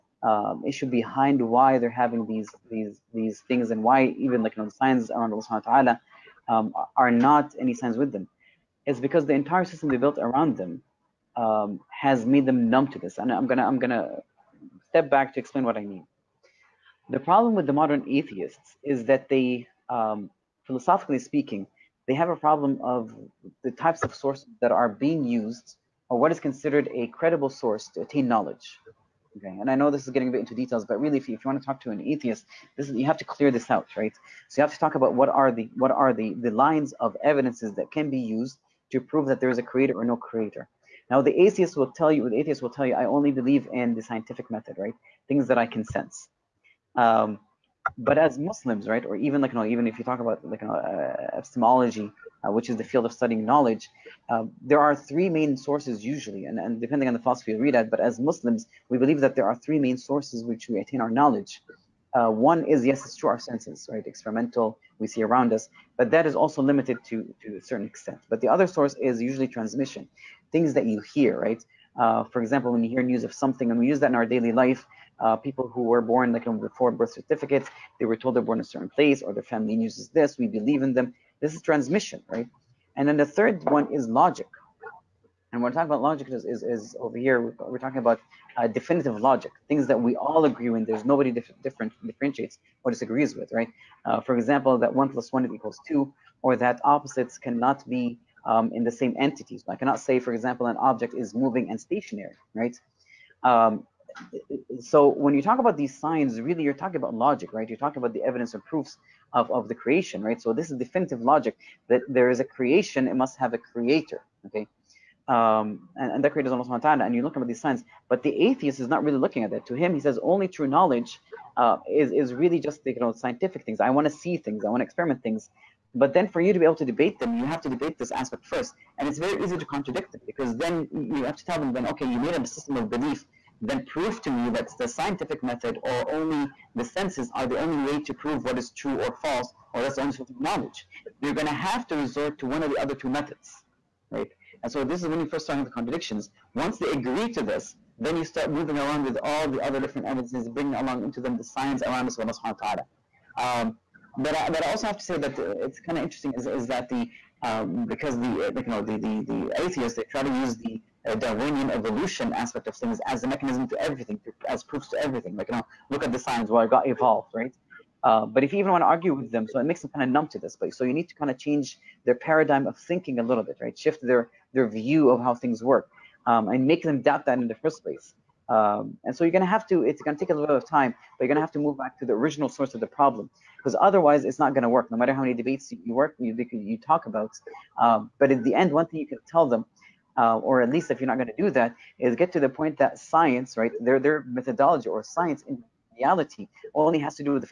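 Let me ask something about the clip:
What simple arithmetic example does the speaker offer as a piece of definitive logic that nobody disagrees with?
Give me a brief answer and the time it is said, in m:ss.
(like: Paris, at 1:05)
1 + 1 = 2, at 1:34.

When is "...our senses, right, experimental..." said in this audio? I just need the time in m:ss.
1:03.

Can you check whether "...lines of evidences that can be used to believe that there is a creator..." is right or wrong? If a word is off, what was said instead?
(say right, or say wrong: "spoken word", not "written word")
wrong: "prove", not "believe".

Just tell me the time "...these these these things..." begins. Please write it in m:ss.
0:02.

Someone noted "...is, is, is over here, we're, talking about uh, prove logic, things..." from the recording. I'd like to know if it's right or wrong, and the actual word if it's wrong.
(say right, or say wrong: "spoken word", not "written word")
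wrong: "definitive", not "prove".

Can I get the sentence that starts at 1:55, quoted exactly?
Um, and, and that creator is Allah subhanahu wa ta'ala, and you're looking at these signs.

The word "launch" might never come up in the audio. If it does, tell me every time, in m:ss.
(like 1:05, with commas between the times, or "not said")
not said.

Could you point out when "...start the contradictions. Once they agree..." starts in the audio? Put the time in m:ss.
2:25.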